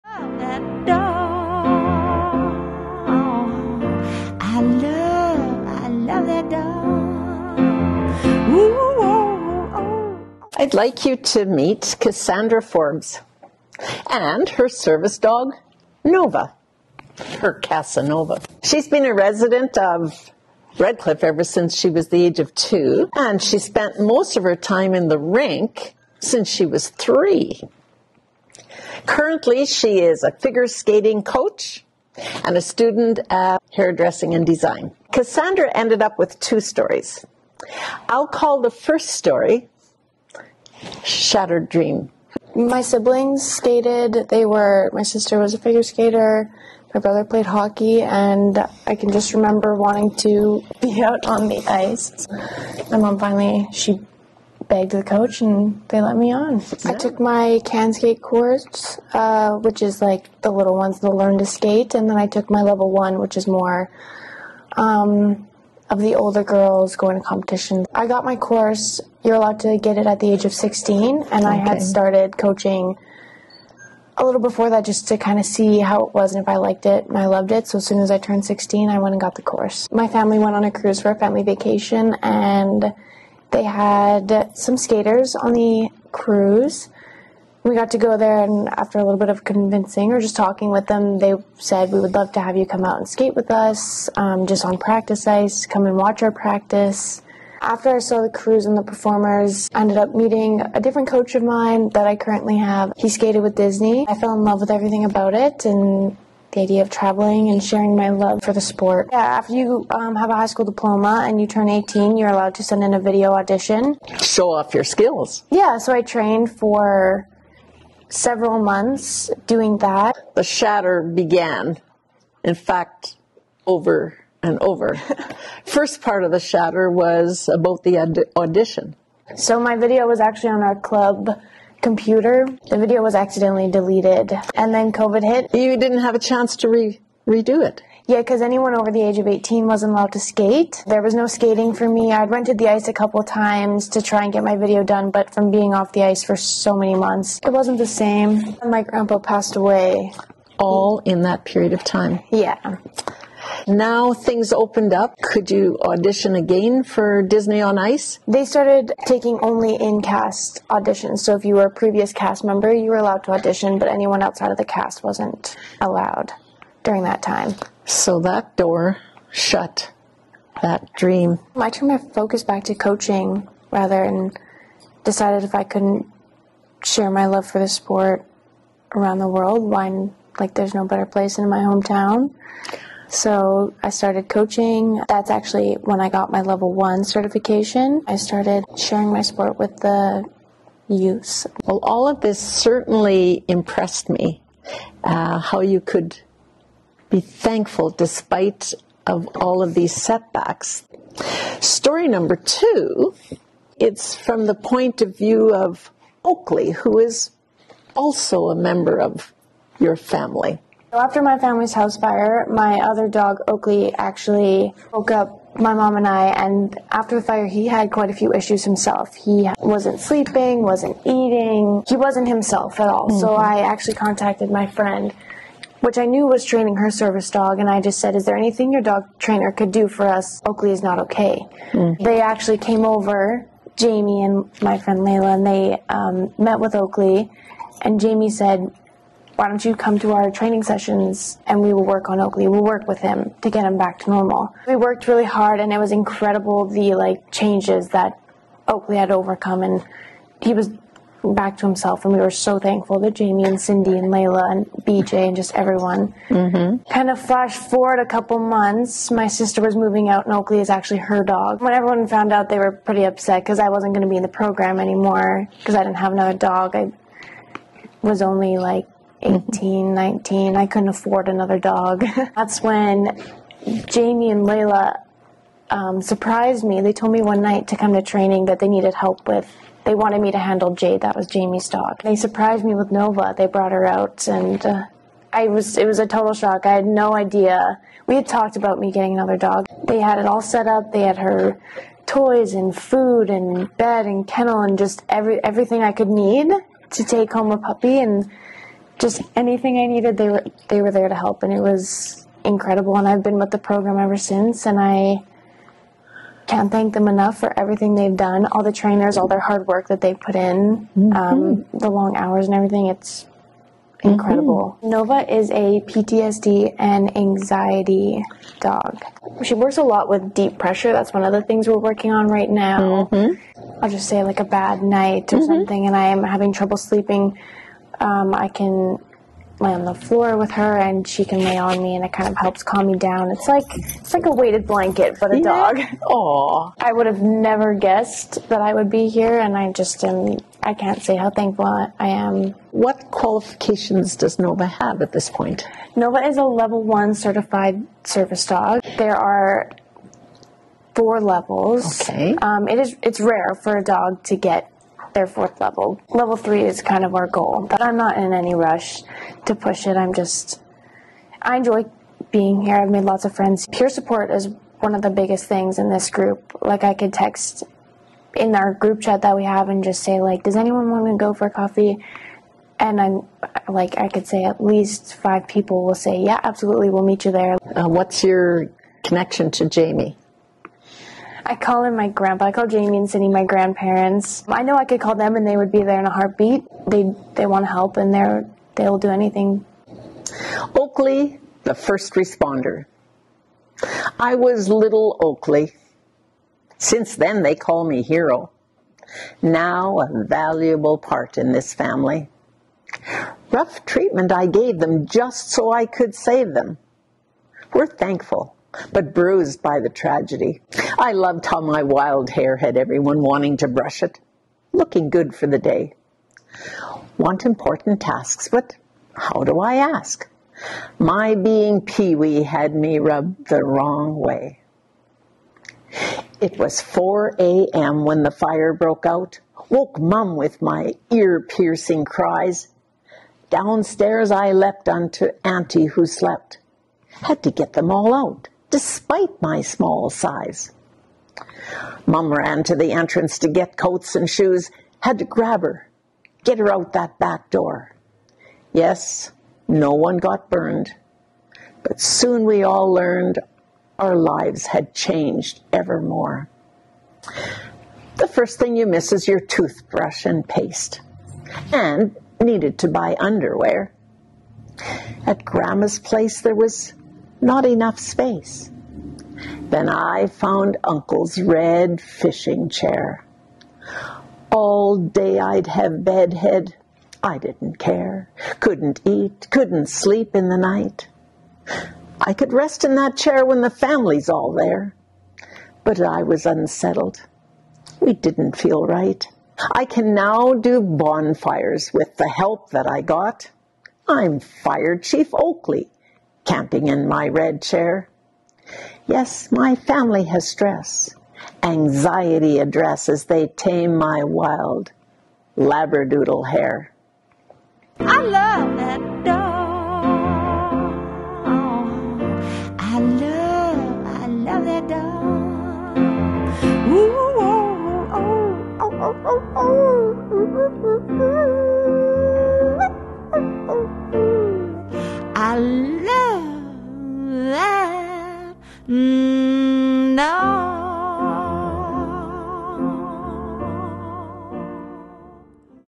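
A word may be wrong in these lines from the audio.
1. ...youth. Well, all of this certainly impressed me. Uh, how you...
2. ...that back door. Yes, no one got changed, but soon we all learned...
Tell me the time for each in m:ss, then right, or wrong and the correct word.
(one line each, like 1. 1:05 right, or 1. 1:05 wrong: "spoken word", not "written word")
1. 3:10 right
2. 7:26 wrong: "burned", not "changed".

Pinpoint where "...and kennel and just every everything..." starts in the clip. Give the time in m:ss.
4:54.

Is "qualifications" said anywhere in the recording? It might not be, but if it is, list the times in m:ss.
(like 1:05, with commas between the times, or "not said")
5:43.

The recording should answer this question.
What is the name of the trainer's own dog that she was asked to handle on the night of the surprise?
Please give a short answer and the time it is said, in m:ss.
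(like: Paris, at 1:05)
Jade, at 4:40.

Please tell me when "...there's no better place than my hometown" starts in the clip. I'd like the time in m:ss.
3:00.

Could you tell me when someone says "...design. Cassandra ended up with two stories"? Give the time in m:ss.
0:34.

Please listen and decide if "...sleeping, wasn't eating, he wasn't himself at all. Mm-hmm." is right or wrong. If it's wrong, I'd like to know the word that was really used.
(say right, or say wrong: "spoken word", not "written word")
right.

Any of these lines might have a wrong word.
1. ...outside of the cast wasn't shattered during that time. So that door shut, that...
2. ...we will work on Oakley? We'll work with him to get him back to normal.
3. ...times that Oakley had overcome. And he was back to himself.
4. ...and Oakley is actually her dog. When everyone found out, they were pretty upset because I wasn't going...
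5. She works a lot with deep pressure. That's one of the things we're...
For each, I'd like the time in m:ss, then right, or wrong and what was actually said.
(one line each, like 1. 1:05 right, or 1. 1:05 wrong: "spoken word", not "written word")
1. 2:44 wrong: "allowed", not "shattered"
2. 4:01 right
3. 4:07 wrong: "changes", not "times"
4. 4:20 right
5. 5:19 right.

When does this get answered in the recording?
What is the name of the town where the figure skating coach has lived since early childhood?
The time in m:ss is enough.
0:20.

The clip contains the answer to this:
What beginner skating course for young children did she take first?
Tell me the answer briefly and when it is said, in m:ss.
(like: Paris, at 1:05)
CanSkate, at 0:57.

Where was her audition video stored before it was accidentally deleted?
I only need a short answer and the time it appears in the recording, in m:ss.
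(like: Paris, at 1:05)
Club computer, at 2:10.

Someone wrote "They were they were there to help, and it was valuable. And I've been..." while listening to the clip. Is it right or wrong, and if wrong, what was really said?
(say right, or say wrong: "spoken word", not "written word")
wrong: "incredible", not "valuable".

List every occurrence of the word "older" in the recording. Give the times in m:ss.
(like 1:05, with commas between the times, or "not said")
1:06.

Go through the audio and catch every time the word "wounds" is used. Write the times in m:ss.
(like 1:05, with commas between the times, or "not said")
not said.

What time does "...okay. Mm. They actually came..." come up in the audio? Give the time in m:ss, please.
3:50.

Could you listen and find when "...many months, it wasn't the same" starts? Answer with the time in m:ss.
2:26.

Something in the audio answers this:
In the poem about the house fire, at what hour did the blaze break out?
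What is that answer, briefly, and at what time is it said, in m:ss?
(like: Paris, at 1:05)
4 a.m., at 7:06.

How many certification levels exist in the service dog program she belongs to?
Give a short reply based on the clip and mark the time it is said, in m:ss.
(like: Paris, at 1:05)
4, at 5:50.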